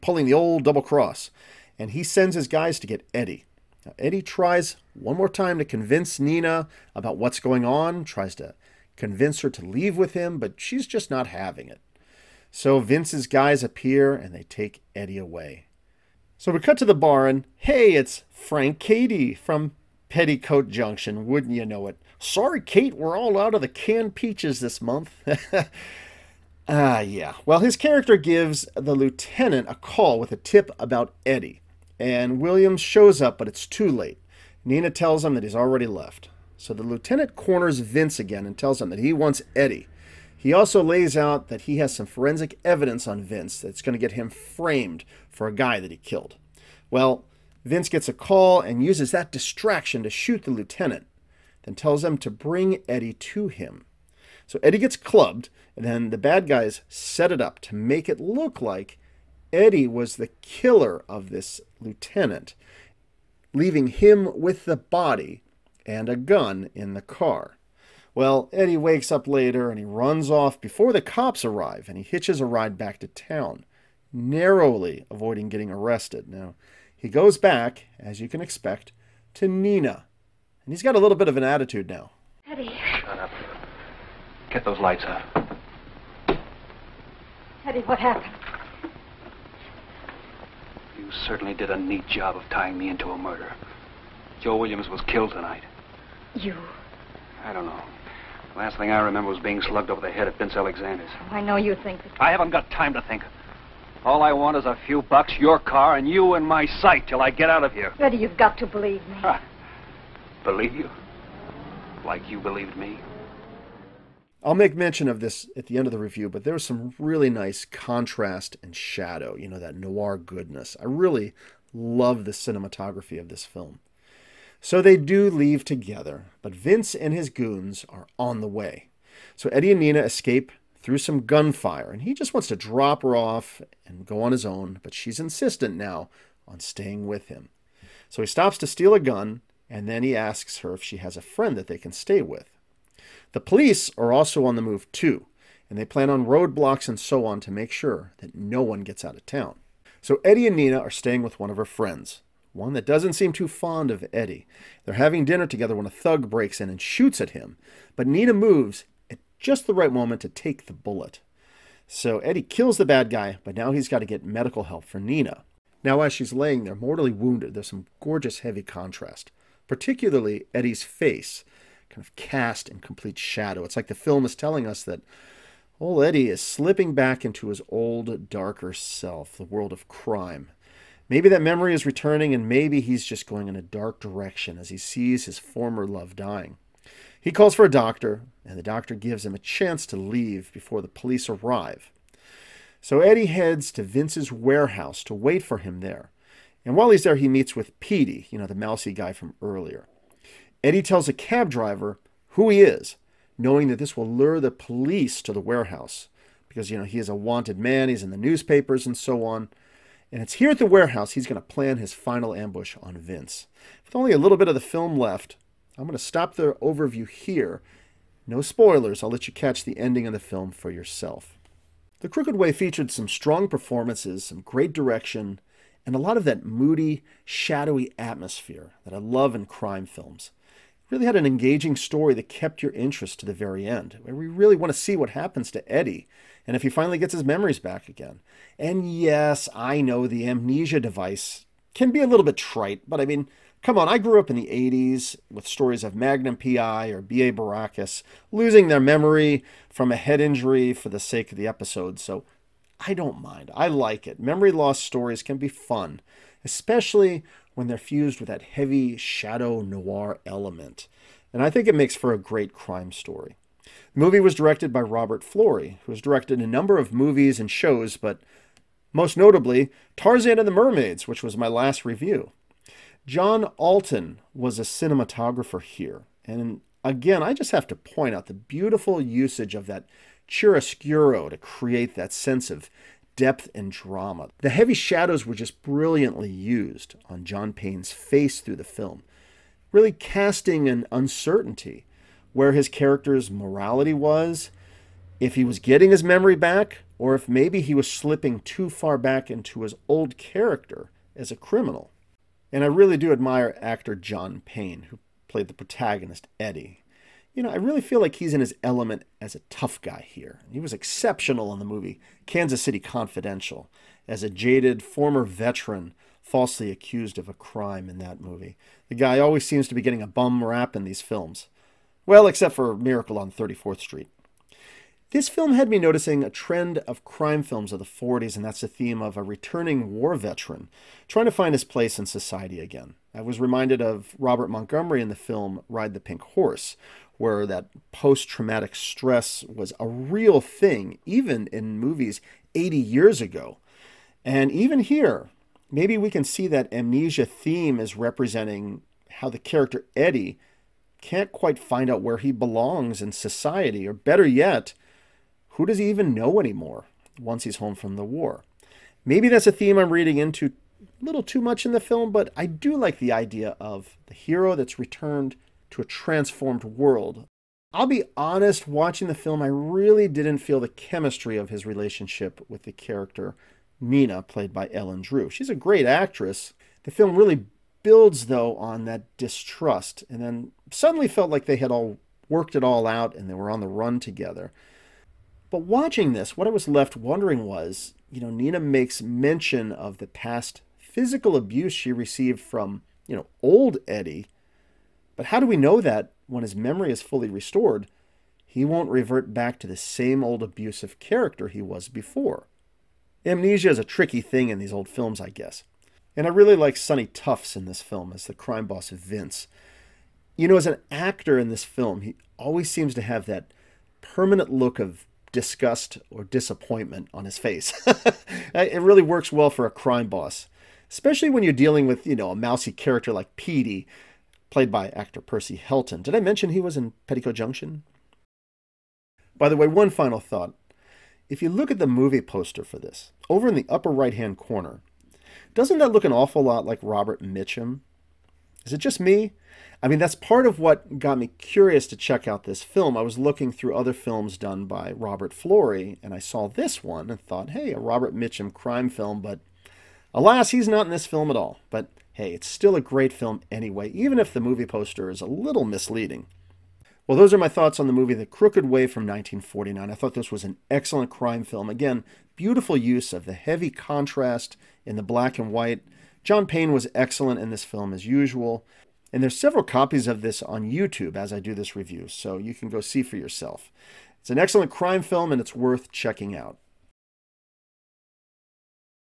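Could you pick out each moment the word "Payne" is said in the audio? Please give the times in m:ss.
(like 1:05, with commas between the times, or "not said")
4:47, 5:04, 7:46.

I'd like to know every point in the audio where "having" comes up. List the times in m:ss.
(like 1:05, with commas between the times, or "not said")
0:11, 2:34.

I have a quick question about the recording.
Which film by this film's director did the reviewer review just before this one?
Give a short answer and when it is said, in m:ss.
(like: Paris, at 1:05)
Tarzan and the Mermaids, at 4:29.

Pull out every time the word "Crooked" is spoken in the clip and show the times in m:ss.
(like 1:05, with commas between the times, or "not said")
3:42, 7:38.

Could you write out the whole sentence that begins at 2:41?
So Eddie kills the bad guy, but now he's got to get medical help for Nina.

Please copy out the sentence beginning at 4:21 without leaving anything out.
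And I think it makes for a great crime story.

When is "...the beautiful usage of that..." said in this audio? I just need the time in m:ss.
4:38.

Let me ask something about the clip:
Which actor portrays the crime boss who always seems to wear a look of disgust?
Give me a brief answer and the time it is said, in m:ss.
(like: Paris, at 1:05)
Sonny Tufts, at 6:46.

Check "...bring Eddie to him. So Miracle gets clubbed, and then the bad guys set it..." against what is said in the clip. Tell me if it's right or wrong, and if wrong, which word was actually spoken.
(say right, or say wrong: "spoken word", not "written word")
wrong: "Eddie", not "Miracle".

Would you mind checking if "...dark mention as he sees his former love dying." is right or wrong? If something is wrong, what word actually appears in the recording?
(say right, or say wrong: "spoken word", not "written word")
wrong: "direction", not "mention".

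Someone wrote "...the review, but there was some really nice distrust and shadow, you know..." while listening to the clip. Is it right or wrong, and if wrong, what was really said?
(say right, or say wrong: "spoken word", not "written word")
wrong: "contrast", not "distrust".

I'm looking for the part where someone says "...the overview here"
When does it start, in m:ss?
3:36.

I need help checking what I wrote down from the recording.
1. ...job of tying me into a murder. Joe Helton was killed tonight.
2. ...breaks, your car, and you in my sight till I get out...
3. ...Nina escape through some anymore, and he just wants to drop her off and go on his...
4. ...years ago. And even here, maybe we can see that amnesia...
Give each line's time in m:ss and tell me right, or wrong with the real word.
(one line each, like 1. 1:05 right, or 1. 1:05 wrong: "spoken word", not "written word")
1. 1:32 wrong: "Williams", not "Helton"
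2. 1:45 wrong: "bucks", not "breaks"
3. 2:09 wrong: "gunfire", not "anymore"
4. 5:42 right.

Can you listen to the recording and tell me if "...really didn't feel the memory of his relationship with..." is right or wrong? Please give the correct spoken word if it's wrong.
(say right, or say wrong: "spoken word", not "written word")
wrong: "chemistry", not "memory".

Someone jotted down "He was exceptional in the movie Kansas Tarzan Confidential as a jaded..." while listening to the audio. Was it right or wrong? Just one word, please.
wrong.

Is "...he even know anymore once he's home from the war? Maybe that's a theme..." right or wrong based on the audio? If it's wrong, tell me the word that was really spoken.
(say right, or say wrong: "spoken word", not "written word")
right.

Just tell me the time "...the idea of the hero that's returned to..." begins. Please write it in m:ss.
6:02.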